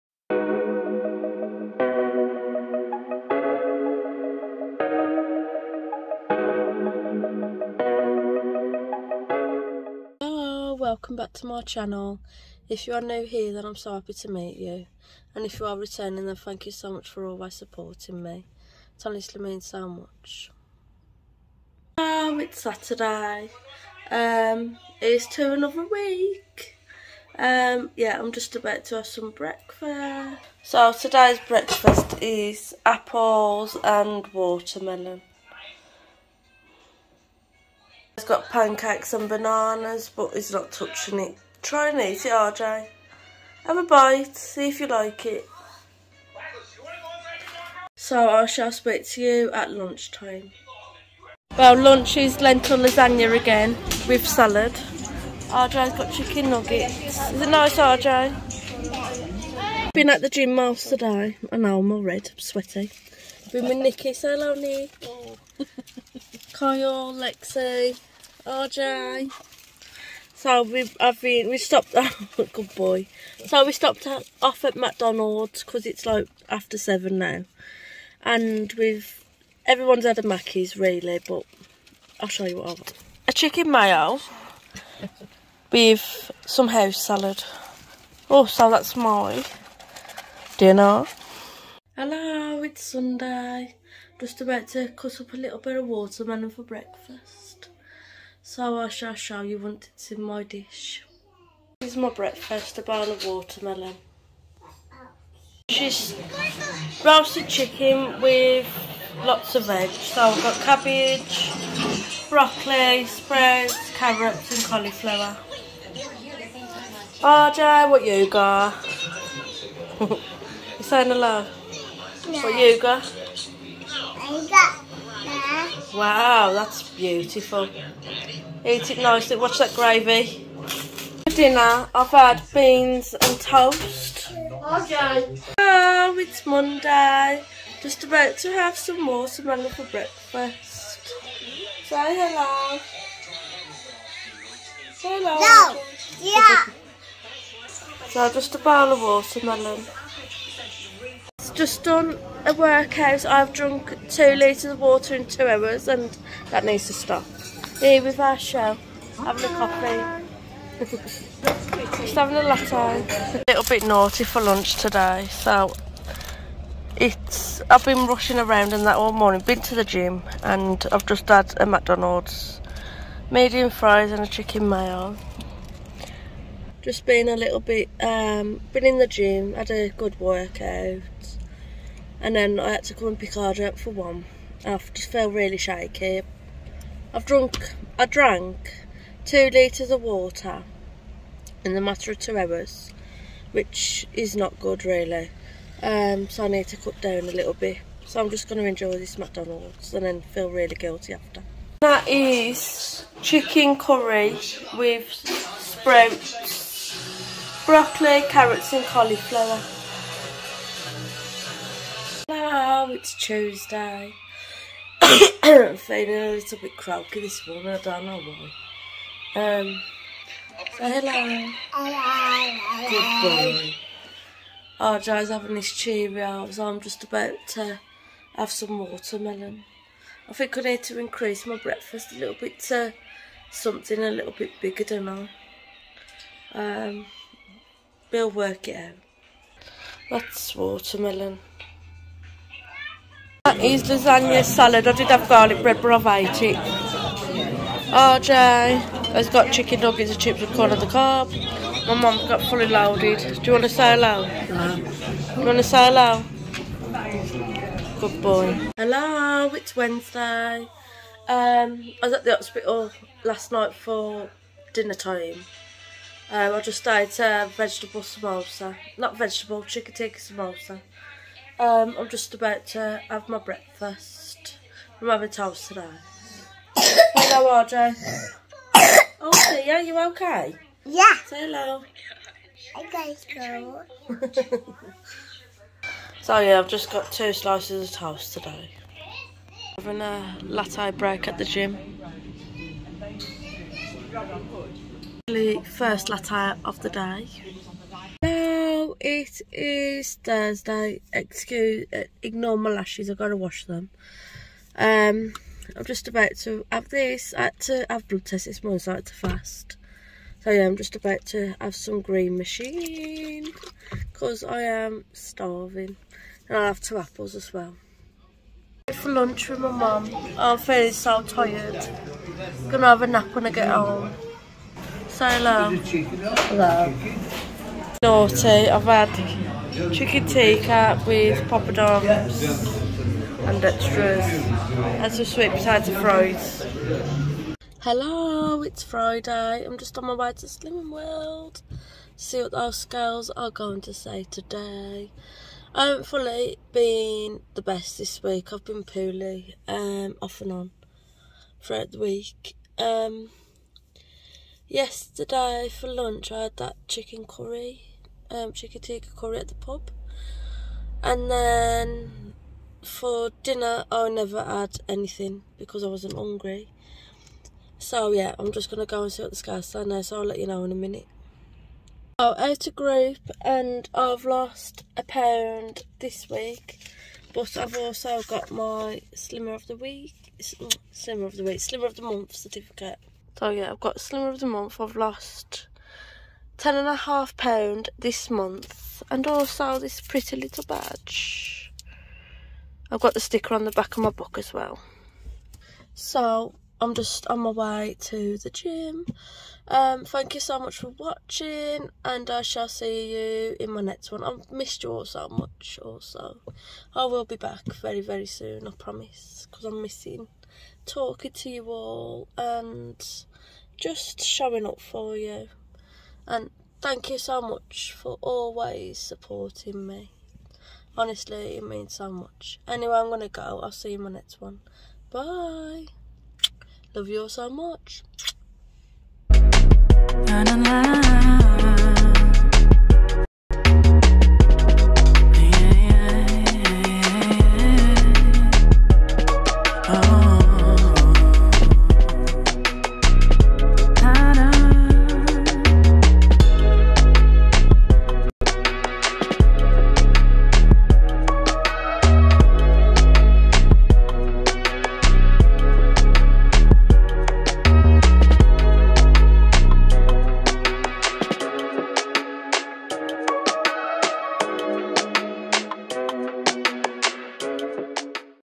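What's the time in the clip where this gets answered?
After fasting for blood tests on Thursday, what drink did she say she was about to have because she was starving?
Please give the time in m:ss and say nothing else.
5:12.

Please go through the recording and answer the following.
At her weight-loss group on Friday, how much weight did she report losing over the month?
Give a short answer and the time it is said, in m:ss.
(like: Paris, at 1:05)
10.5 pounds, at 6:26.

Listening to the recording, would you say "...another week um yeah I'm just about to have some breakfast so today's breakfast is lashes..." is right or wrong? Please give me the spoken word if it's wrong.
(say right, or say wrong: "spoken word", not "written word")
wrong: "apples", not "lashes".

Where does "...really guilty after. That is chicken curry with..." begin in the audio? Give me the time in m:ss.
3:20.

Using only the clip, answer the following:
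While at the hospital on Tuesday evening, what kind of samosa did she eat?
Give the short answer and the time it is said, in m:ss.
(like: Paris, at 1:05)
Chicken tikka samosa, at 4:29.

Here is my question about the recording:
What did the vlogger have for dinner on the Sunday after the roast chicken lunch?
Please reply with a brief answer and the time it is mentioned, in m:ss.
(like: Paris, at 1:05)
Beans and toast, at 2:12.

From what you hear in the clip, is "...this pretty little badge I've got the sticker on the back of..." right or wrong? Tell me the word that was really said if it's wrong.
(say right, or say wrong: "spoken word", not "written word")
right.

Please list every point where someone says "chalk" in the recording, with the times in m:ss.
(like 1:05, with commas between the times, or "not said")
not said.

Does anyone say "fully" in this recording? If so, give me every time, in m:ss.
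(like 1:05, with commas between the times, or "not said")
4:12, 5:46.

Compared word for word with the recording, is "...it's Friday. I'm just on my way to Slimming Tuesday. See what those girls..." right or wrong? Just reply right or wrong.
wrong.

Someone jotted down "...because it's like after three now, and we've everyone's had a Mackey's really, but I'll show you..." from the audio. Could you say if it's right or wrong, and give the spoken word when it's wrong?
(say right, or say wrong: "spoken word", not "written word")
wrong: "seven", not "three".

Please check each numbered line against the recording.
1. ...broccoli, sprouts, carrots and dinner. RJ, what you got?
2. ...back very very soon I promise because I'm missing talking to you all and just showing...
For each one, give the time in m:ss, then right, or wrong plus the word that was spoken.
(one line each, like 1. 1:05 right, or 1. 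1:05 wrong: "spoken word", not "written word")
1. 1:52 wrong: "cauliflower", not "dinner"
2. 6:47 right.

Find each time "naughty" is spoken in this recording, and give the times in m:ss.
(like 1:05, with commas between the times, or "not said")
2:43, 5:28.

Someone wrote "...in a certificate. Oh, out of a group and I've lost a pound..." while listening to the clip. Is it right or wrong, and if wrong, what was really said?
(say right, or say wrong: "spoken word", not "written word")
wrong: "minute", not "certificate".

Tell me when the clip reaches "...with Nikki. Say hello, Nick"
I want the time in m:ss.
1:03.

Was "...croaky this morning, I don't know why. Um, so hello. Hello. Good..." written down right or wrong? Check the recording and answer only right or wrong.
right.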